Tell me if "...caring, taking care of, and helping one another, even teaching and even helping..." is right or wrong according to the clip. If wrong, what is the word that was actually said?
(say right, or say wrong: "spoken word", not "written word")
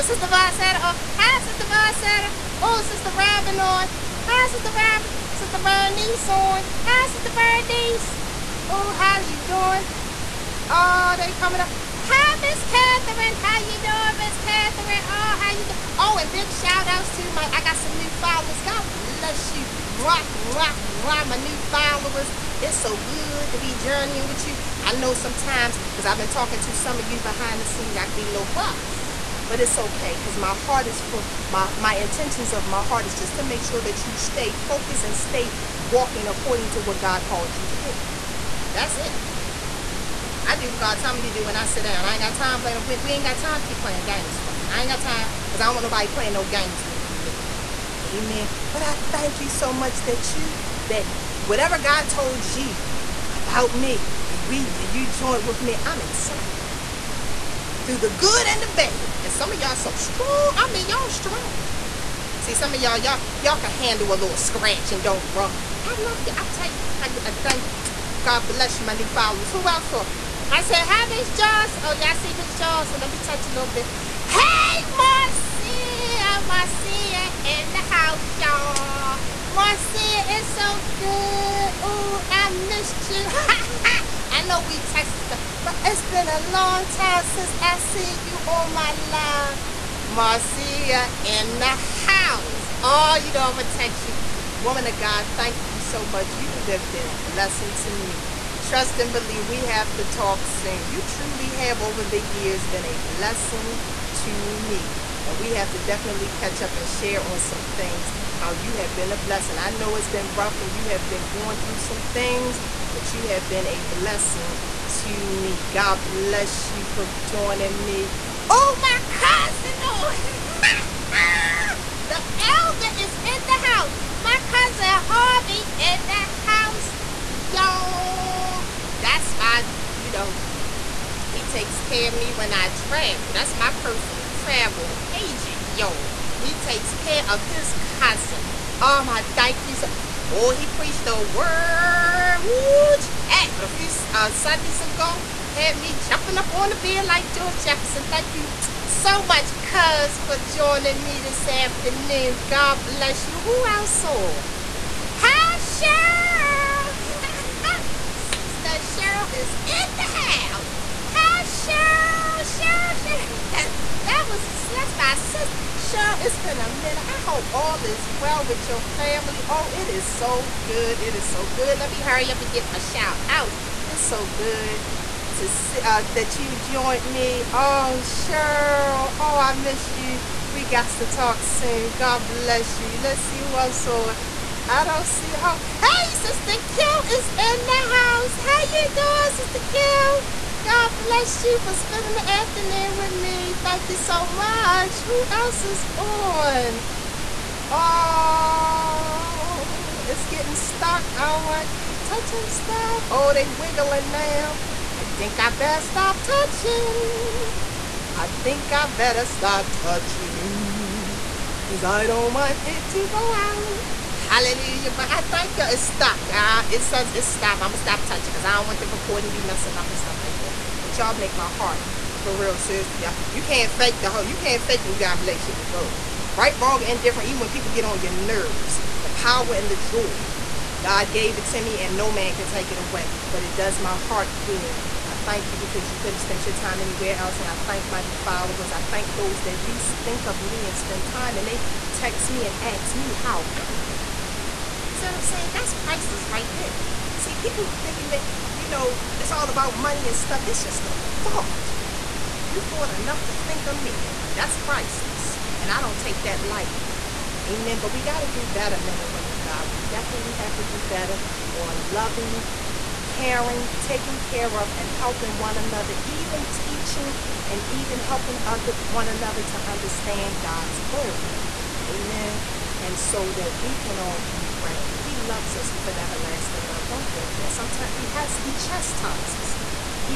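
right.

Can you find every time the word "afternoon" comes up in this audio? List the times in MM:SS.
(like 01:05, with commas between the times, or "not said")
02:31, 03:12.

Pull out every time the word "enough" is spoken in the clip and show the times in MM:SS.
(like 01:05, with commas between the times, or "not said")
04:12.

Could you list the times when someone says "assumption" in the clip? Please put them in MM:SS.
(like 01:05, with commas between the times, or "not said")
not said.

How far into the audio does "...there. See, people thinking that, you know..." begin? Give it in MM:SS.
04:06.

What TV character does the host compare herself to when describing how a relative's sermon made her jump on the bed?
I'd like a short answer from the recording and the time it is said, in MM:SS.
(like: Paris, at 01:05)
George Jefferson, at 02:27.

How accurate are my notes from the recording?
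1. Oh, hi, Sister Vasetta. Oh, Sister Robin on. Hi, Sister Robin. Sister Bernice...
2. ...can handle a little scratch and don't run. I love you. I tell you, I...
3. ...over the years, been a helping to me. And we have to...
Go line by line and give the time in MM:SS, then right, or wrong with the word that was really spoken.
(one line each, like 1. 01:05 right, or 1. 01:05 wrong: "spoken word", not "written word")
1. 00:00 right
2. 01:03 right
3. 01:41 wrong: "blessing", not "helping".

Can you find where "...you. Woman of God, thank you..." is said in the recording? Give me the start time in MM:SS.
01:34.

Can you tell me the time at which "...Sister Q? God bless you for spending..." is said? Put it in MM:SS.
03:09.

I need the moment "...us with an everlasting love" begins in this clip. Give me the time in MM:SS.
04:35.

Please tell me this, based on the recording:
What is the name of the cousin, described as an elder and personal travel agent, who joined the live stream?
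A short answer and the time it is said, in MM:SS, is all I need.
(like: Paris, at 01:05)
Harvey, at 02:05.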